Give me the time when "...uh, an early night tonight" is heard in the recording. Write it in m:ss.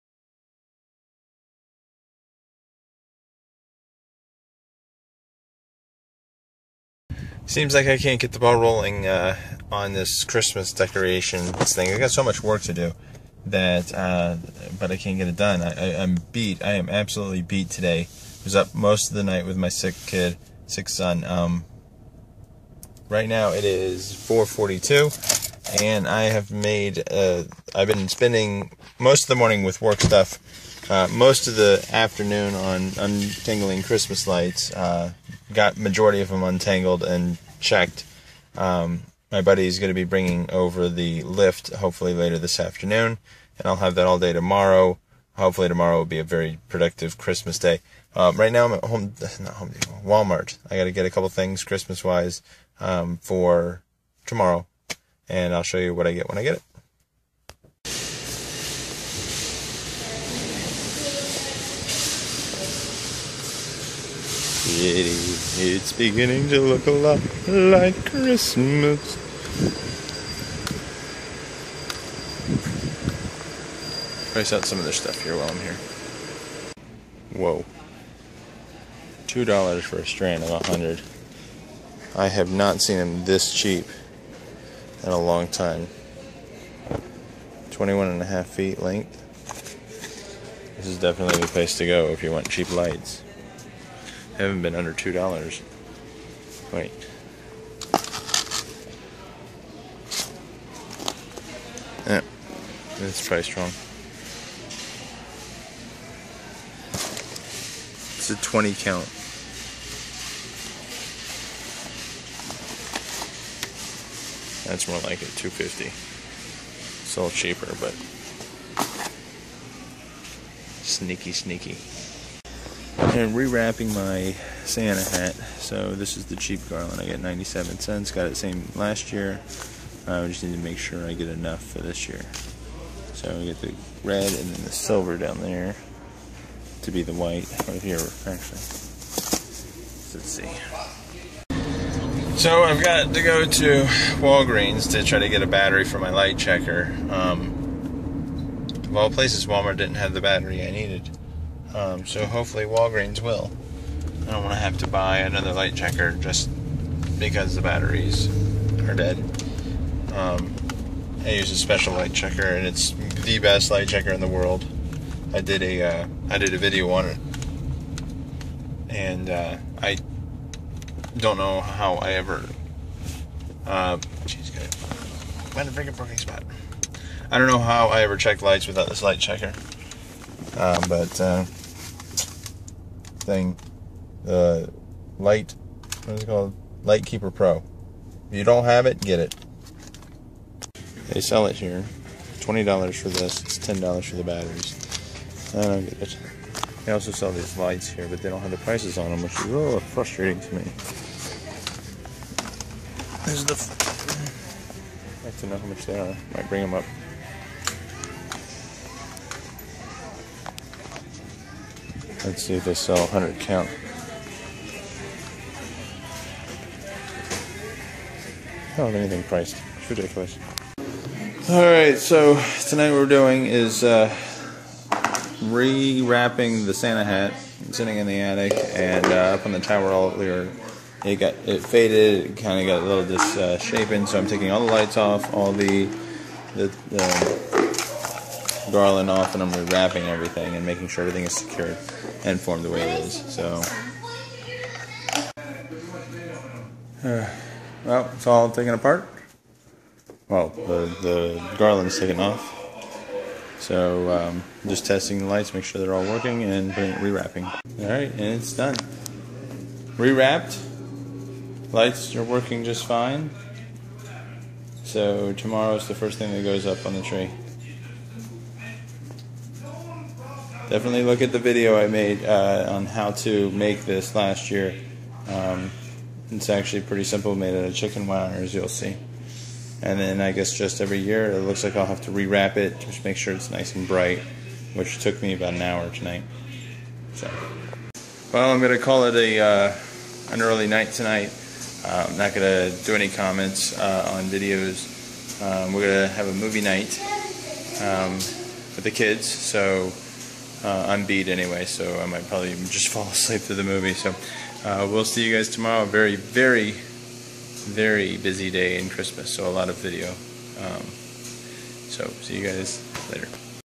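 4:49.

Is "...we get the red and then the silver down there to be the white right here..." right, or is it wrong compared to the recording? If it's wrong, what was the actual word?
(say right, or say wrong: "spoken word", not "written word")
right.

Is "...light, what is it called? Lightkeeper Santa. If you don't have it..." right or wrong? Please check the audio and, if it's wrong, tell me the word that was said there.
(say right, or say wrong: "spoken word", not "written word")
wrong: "Pro", not "Santa".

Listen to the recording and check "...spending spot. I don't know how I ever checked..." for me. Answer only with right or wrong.
wrong.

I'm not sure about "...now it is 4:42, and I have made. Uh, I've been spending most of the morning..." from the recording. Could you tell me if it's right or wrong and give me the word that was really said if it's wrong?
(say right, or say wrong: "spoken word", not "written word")
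right.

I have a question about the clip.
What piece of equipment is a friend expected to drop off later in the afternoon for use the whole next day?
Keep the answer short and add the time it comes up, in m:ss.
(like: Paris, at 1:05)
the lift, at 0:40.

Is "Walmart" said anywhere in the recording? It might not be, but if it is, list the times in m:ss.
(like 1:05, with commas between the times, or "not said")
0:50, 2:29.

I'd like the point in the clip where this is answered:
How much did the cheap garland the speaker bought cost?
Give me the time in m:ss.
2:07.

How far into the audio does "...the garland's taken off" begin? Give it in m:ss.
4:11.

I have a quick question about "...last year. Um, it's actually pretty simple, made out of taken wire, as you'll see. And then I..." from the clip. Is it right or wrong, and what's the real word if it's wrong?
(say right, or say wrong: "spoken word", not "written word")
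wrong: "chicken", not "taken".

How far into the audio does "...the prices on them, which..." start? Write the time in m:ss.
3:18.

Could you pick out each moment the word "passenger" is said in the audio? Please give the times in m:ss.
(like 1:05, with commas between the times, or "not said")
not said.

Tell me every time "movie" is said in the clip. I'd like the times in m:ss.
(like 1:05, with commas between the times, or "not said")
4:56, 5:03.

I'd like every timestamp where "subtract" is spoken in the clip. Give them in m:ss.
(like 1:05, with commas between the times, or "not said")
not said.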